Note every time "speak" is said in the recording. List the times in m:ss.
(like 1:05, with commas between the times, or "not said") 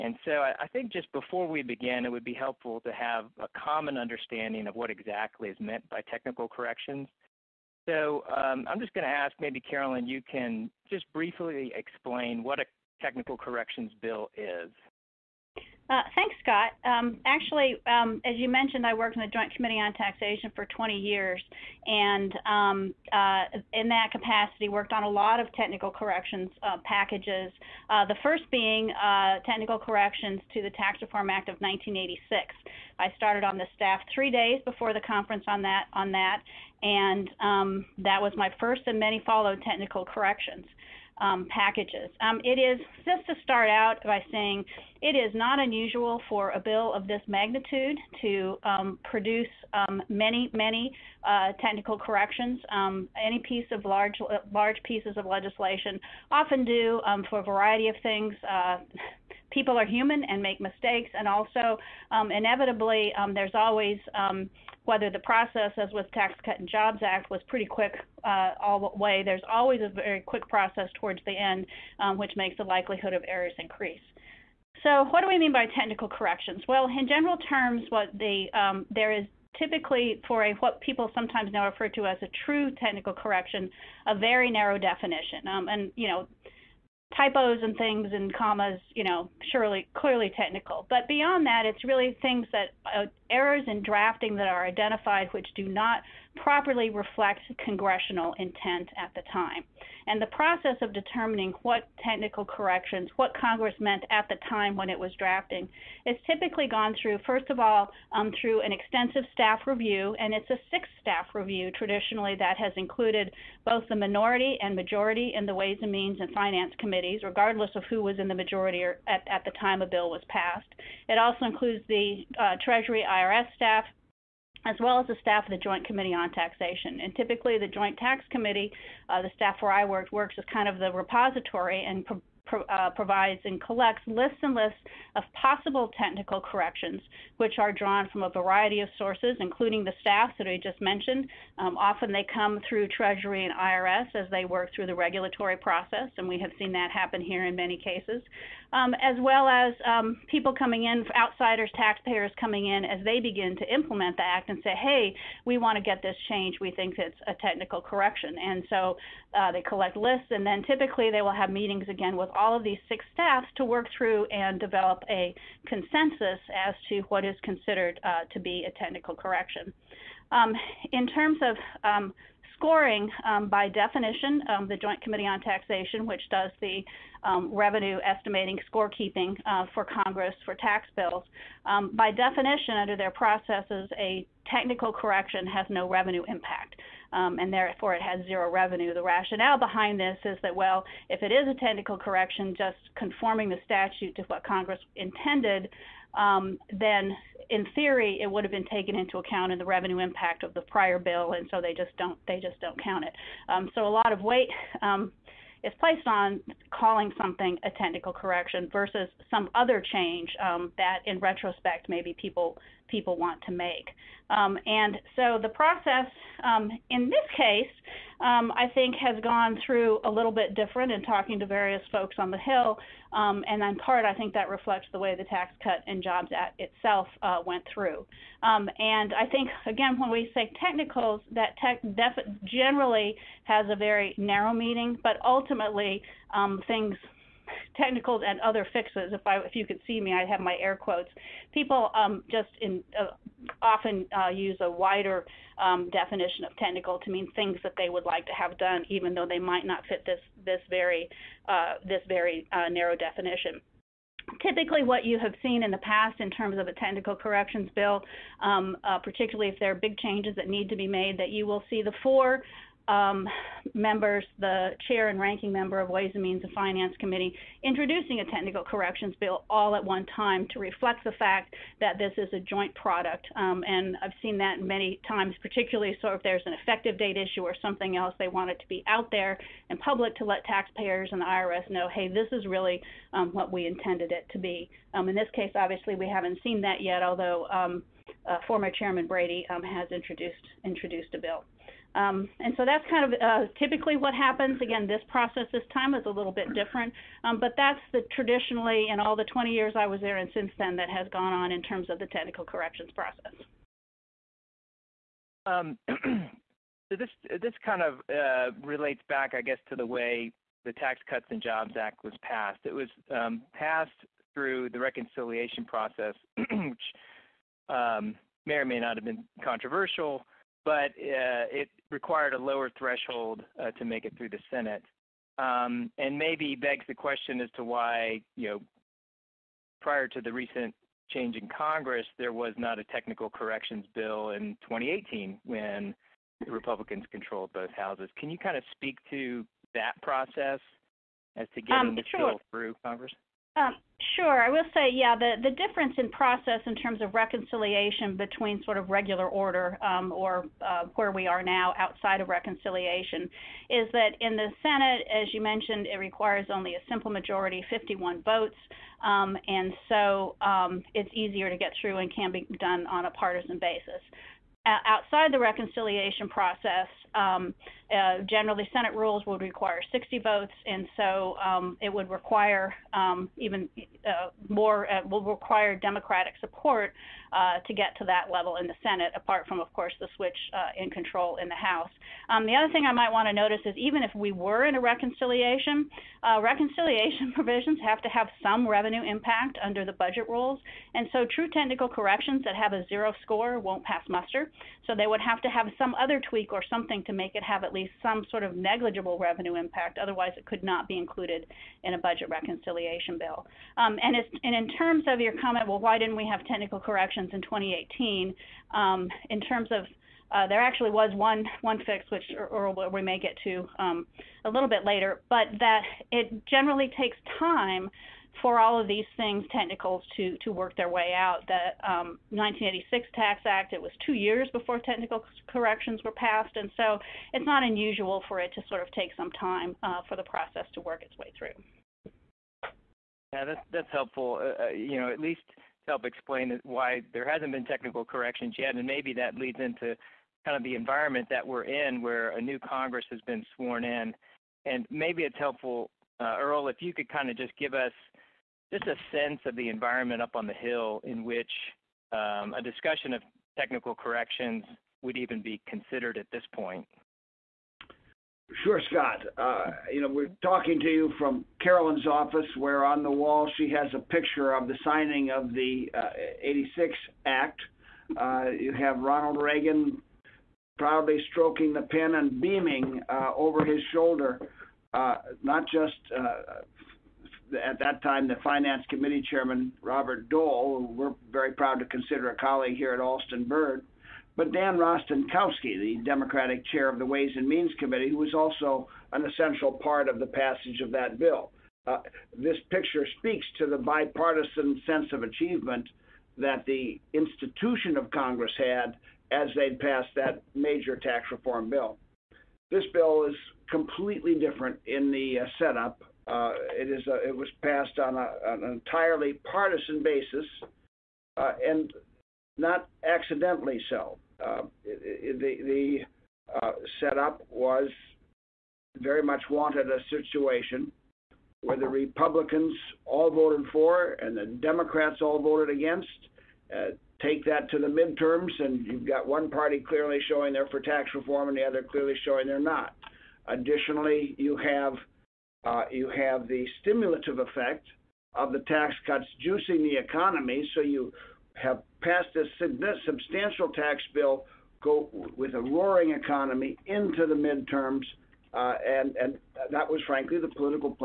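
5:38, 8:13.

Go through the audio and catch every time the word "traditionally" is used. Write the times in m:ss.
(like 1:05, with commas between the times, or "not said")
1:51, 4:58.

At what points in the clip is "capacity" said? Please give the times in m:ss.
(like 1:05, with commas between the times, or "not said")
0:24.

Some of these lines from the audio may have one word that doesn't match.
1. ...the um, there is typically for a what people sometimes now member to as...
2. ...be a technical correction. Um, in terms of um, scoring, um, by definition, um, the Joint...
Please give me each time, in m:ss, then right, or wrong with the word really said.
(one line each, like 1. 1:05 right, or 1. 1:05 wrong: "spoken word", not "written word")
1. 1:18 wrong: "refer", not "member"
2. 2:48 right.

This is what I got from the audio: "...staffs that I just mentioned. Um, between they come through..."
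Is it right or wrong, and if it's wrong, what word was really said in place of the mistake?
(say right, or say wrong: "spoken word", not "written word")
wrong: "often", not "between".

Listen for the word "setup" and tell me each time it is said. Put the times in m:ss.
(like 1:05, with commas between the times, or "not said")
8:25, 8:37.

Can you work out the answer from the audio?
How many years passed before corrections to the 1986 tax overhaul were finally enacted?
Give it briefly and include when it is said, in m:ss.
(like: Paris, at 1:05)
2 years, at 7:04.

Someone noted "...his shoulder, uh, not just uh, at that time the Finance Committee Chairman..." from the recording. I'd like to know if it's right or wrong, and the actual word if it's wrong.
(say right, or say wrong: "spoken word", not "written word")
right.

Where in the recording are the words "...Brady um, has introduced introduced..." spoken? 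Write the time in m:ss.
4:49.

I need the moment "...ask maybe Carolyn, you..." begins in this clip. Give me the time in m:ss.
0:09.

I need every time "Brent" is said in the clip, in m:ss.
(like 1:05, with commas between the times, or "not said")
not said.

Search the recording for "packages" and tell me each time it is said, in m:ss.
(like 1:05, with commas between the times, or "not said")
0:26, 0:41.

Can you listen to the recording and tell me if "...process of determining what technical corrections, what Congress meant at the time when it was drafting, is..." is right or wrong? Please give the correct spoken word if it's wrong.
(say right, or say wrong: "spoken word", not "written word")
right.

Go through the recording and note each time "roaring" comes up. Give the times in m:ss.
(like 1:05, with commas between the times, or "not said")
9:05.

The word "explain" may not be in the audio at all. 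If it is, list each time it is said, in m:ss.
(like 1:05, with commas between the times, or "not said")
0:11, 7:16.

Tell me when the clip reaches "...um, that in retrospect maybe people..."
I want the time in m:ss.
3:30.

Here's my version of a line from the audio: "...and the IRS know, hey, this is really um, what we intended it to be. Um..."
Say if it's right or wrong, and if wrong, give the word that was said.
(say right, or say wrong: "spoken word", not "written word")
right.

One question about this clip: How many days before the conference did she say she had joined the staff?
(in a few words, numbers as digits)
3.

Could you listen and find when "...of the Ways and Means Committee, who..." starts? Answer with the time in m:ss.
8:06.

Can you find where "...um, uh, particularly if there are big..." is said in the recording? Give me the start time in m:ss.
4:18.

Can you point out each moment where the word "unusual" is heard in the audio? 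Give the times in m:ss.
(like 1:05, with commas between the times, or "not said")
0:45, 7:07.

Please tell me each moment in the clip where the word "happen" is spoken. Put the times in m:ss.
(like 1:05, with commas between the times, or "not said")
2:26, 4:54.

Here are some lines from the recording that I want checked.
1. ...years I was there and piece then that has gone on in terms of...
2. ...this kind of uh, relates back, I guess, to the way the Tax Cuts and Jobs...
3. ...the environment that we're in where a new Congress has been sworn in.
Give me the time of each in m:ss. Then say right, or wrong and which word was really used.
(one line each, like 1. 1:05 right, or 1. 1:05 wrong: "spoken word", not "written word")
1. 4:59 wrong: "since", not "piece"
2. 5:07 right
3. 7:20 right.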